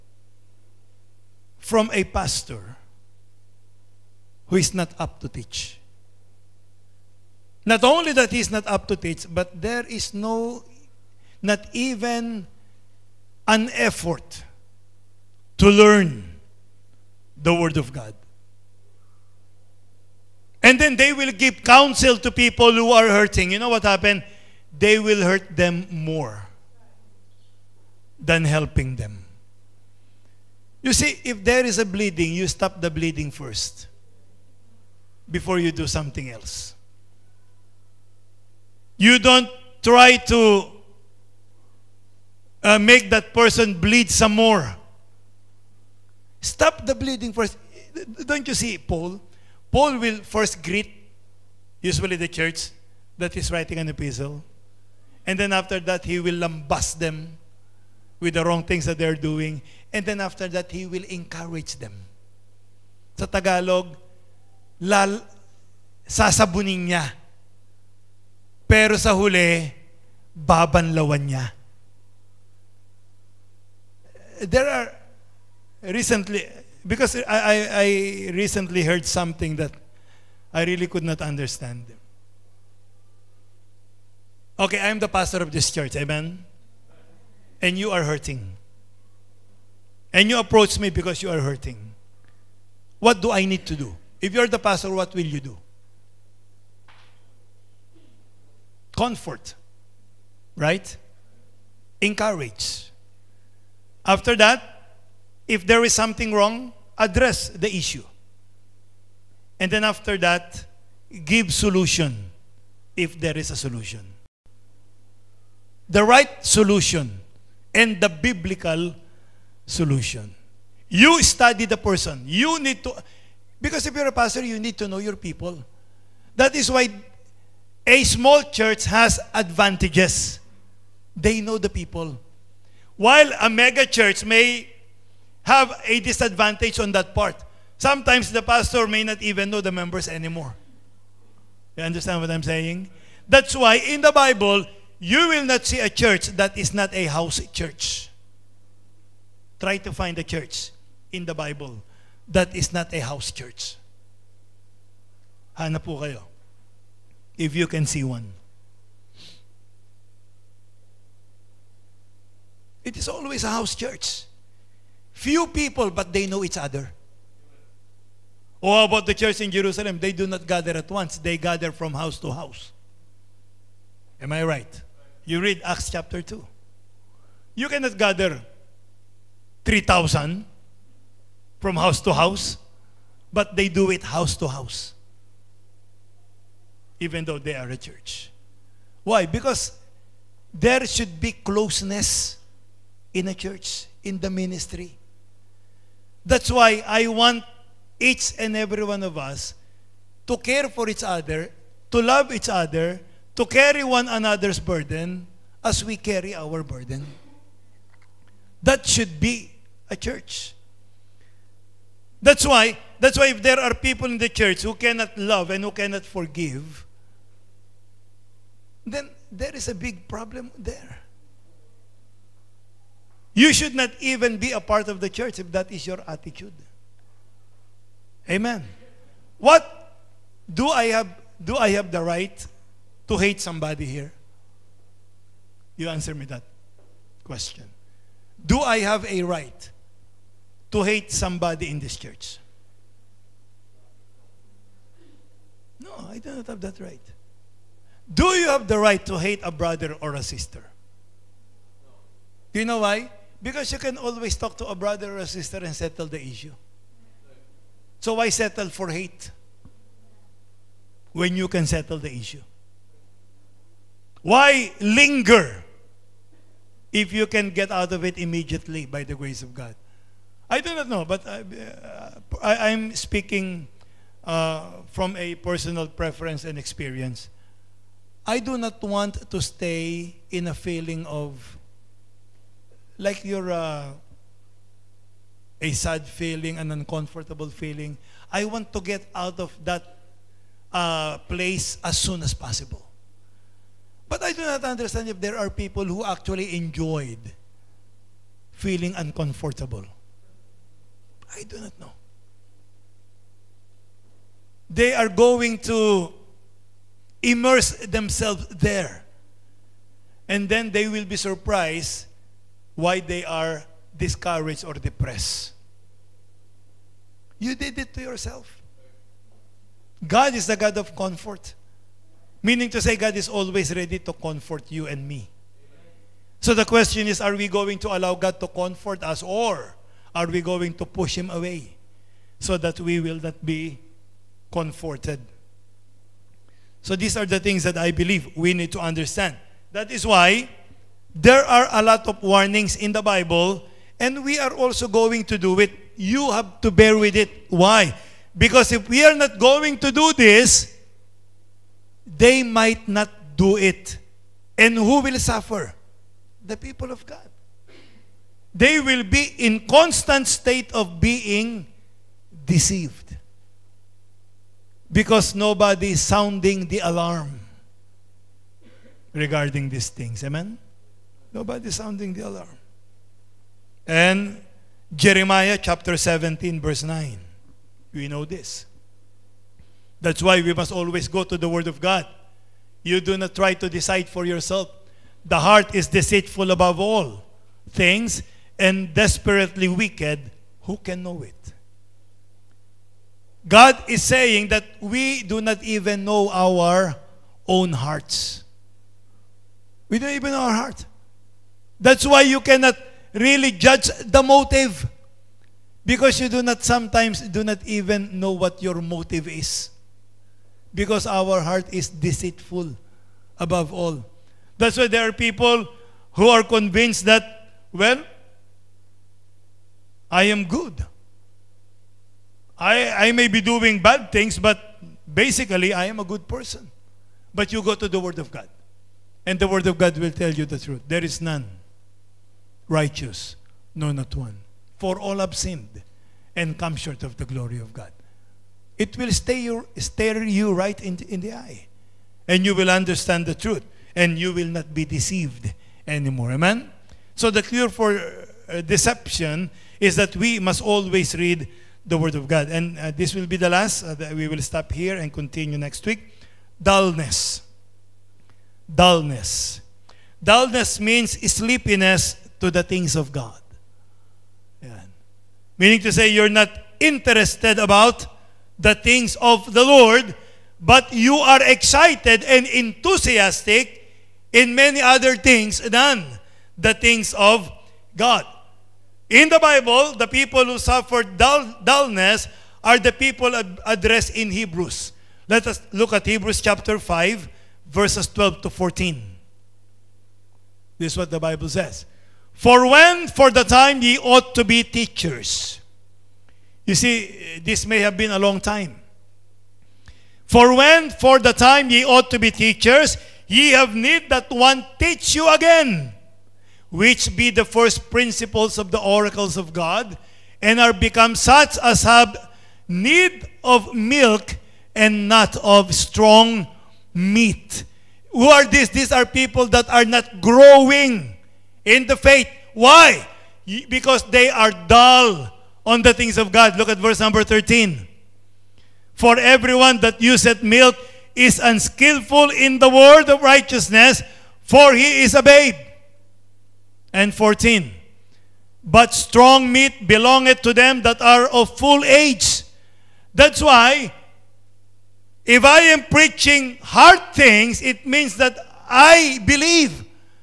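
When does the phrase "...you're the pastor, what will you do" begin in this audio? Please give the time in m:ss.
1:34.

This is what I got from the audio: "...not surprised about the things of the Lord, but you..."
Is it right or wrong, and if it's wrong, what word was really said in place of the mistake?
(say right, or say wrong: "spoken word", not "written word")
wrong: "interested", not "surprised".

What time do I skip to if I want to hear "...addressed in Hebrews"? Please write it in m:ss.
8:03.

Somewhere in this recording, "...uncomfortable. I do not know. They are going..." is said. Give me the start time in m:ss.
4:58.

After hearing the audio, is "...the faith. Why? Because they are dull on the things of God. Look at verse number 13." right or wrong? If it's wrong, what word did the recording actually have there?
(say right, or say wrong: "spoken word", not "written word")
right.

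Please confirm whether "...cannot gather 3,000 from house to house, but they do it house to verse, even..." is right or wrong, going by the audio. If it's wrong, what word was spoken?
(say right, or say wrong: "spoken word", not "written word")
wrong: "house", not "verse".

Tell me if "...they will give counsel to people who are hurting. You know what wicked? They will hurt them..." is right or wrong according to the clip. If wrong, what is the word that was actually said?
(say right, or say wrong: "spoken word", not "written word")
wrong: "happened", not "wicked".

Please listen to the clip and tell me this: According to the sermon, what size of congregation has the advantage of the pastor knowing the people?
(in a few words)
Small church.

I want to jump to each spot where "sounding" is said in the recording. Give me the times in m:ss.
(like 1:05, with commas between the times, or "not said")
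6:06, 6:11.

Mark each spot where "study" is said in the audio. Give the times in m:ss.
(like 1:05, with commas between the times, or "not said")
2:01.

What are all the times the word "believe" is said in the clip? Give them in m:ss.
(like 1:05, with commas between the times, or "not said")
5:37, 9:09.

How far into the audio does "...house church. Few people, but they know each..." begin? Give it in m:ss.
2:43.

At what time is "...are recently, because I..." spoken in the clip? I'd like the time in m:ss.
1:14.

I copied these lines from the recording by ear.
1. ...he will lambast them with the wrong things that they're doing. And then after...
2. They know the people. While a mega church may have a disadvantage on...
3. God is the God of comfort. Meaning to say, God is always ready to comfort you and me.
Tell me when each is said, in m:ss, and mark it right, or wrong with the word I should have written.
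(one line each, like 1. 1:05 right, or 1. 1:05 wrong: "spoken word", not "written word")
1. 0:56 right
2. 2:11 right
3. 5:20 right.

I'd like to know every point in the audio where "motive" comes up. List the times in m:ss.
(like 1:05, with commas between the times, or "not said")
6:44, 6:48.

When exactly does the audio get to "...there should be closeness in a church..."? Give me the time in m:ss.
3:10.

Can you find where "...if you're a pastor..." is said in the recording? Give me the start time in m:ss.
2:03.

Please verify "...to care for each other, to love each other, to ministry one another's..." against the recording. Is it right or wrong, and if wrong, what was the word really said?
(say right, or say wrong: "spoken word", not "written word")
wrong: "carry", not "ministry".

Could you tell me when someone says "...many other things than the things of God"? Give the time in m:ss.
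7:54.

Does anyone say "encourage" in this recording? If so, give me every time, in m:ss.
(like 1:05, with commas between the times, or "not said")
1:01, 1:42.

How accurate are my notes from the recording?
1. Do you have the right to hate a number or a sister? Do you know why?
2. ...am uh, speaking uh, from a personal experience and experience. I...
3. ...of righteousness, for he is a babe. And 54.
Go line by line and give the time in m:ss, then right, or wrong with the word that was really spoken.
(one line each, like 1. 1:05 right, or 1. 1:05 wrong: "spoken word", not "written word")
1. 4:08 wrong: "brother", not "number"
2. 4:32 wrong: "preference", not "experience"
3. 8:53 wrong: "14", not "54".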